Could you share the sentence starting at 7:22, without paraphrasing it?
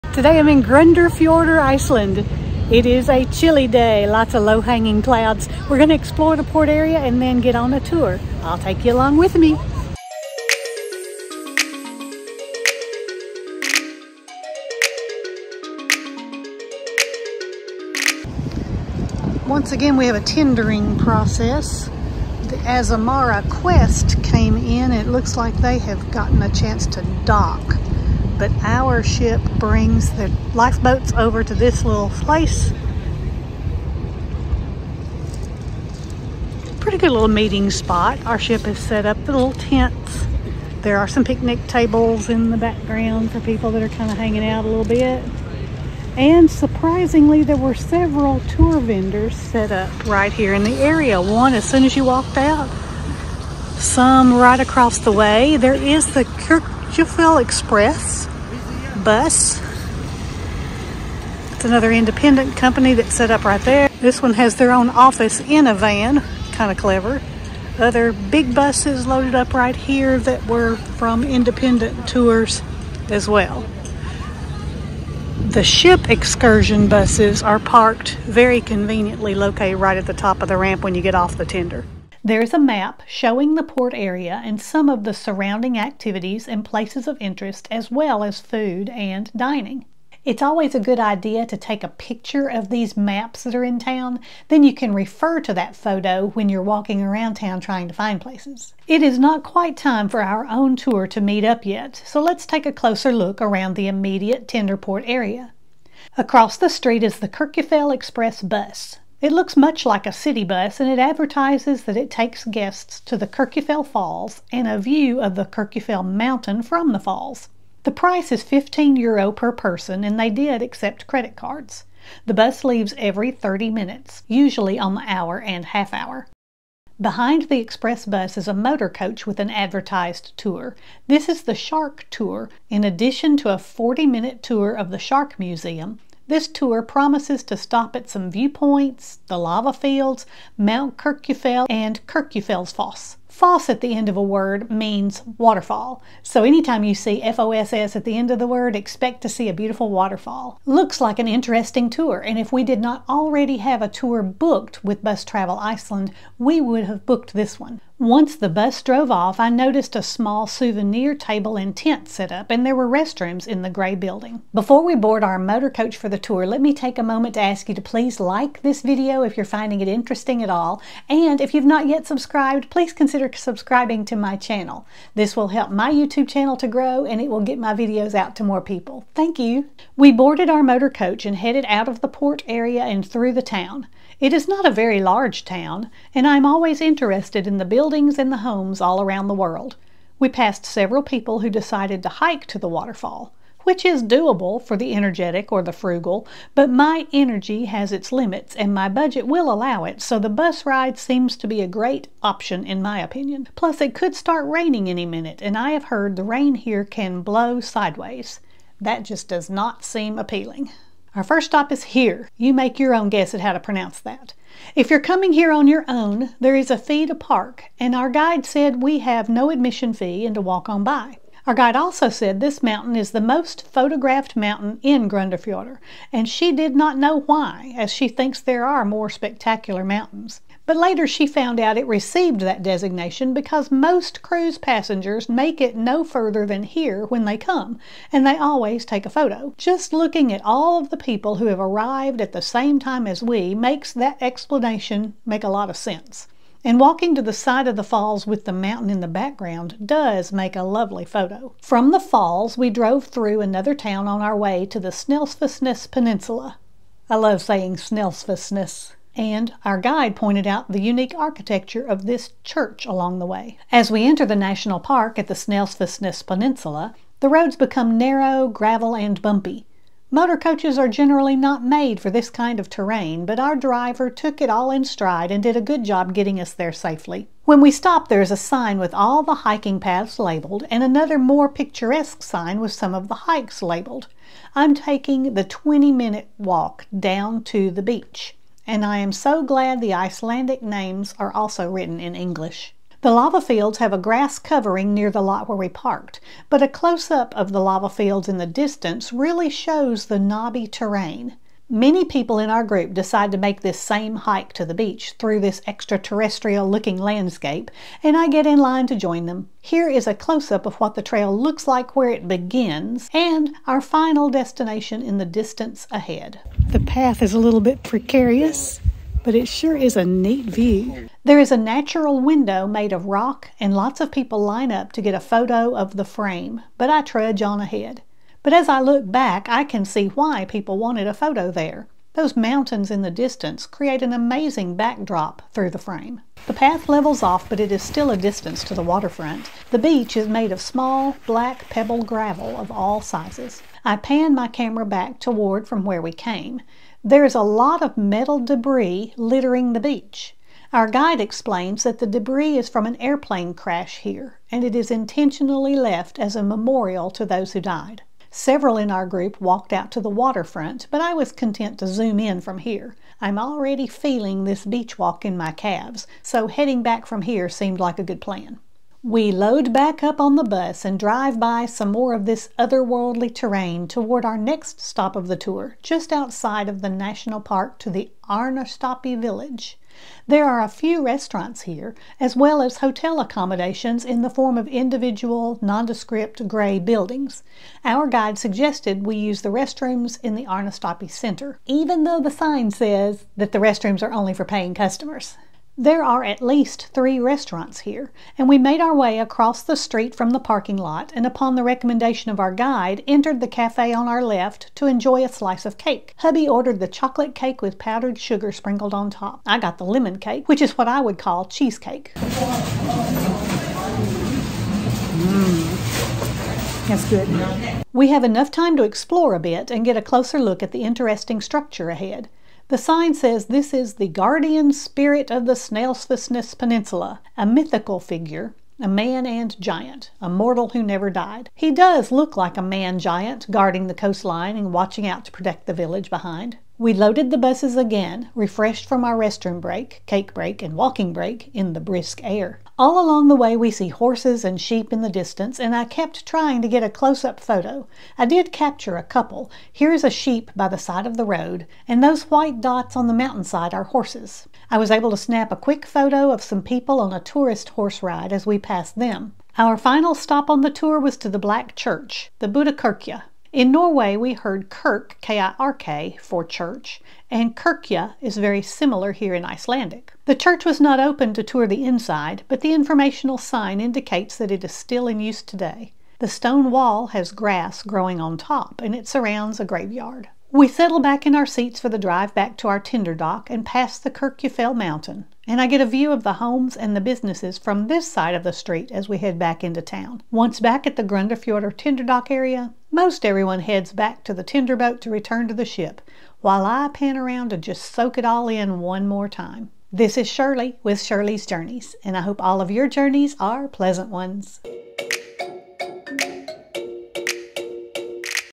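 All along the way, we see horses and sheep in the distance, and I kept trying to get a close up photo.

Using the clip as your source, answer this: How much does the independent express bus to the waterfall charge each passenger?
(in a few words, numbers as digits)
15 euro.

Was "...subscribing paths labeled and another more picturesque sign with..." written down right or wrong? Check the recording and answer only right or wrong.
wrong.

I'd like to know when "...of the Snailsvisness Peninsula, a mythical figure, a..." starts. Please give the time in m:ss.
7:05.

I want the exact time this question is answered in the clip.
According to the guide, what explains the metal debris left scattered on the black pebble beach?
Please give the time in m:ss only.
5:52.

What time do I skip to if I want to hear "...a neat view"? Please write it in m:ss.
5:19.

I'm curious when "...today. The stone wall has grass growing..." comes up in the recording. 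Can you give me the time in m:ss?
7:55.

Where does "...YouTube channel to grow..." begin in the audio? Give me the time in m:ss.
2:55.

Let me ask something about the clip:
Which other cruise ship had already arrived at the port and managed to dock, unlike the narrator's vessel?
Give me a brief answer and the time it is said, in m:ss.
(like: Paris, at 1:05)
Azamara Quest, at 0:22.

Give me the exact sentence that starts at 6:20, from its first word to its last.
There are a few restaurants here, as well as hotel accommodations in the form of individual, nondescript gray buildings.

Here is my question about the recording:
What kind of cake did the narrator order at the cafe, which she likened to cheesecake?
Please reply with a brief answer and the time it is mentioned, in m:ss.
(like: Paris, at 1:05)
Lemon cake, at 6:49.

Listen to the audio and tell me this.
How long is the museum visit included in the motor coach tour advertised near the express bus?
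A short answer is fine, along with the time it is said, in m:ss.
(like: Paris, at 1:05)
40 minute, at 2:13.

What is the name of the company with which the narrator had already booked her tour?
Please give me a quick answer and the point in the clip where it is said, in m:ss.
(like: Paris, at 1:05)
Bus Travel Iceland, at 2:35.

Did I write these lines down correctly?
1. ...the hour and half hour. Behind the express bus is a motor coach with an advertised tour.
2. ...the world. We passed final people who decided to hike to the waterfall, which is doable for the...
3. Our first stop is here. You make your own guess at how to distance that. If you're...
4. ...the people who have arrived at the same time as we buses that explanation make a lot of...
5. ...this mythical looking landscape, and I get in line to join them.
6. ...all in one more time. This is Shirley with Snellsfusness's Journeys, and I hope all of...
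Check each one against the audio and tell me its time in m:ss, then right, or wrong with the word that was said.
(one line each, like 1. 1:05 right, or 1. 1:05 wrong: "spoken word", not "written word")
1. 2:04 right
2. 3:09 wrong: "several", not "final"
3. 3:31 wrong: "pronounce", not "distance"
4. 4:00 wrong: "makes", not "buses"
5. 5:05 wrong: "extraterrestrial", not "mythical"
6. 8:18 wrong: "Shirley", not "Snellsfusness".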